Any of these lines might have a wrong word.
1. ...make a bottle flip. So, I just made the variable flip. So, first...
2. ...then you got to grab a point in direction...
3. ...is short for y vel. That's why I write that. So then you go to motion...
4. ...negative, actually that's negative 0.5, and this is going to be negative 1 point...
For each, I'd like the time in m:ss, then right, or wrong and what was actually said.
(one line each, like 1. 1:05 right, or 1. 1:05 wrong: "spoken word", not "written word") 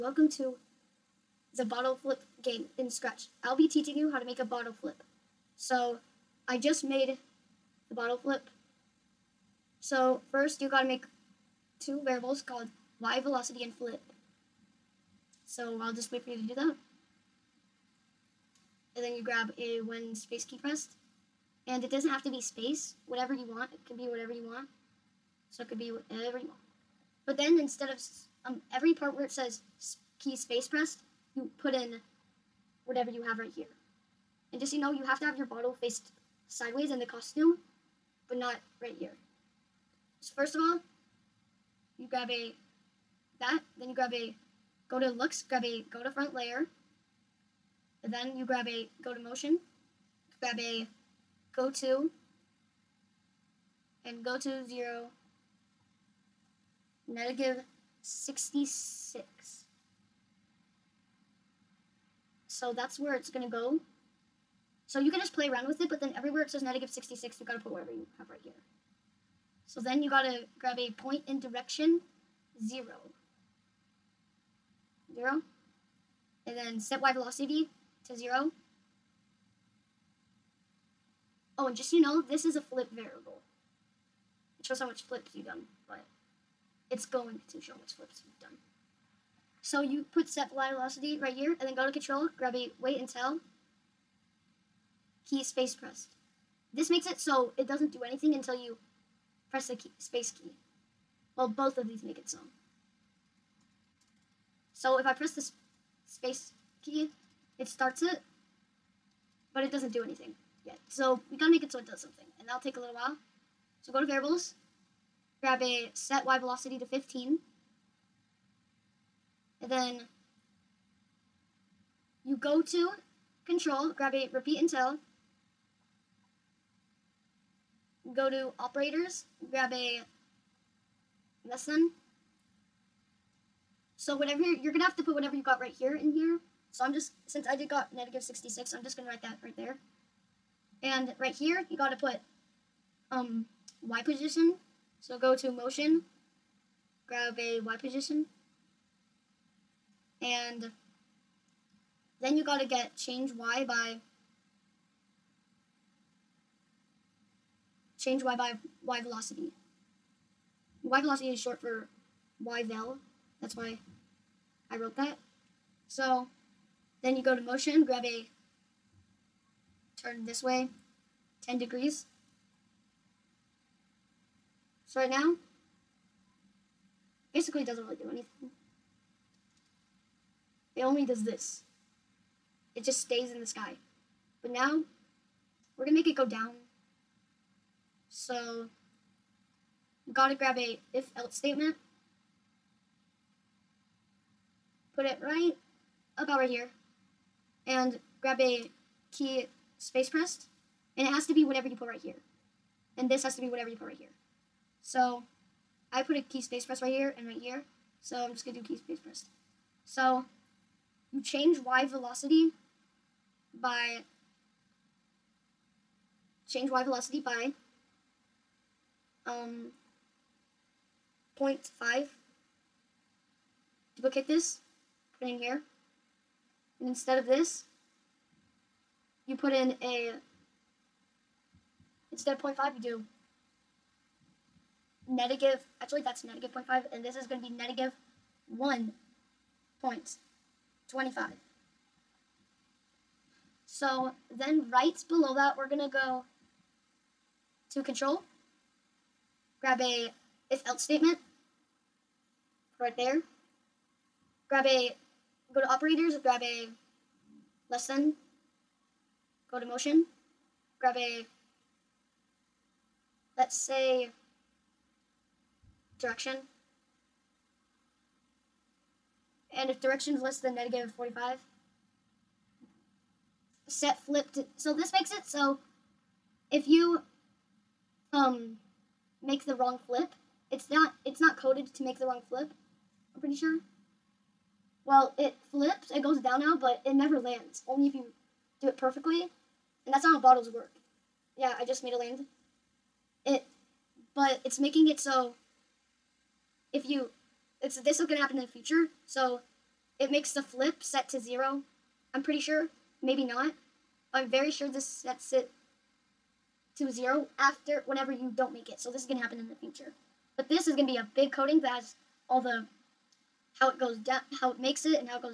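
1. 0:04 wrong: "bottle", not "variable"
2. 1:09 right
3. 2:41 wrong: "wrote", not "write"
4. 3:55 right.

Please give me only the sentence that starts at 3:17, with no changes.
And grab a key space pressed.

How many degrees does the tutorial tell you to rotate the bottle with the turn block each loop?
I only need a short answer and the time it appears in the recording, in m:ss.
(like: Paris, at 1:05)
10 degrees, at 2:51.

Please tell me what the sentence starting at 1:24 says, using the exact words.
It shows how much flips you've done, but it's going to show how much flips you've done.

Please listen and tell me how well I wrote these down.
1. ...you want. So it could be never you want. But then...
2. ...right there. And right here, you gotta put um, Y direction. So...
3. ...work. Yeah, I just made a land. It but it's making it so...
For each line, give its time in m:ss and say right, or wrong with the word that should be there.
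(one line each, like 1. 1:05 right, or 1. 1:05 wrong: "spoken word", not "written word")
1. 0:24 wrong: "whatever", not "never"
2. 2:19 wrong: "position", not "direction"
3. 4:50 right.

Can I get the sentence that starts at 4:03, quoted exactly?
So then right below that, we're going to go to control.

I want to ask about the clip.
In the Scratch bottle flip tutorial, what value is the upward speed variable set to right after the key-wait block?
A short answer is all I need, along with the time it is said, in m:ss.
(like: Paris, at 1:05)
15, at 1:55.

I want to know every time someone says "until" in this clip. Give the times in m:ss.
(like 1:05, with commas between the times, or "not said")
1:33, 1:38, 2:04.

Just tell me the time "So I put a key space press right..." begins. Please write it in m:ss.
3:24.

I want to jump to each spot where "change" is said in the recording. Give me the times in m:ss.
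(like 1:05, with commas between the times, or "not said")
2:32, 2:37, 3:31, 3:36.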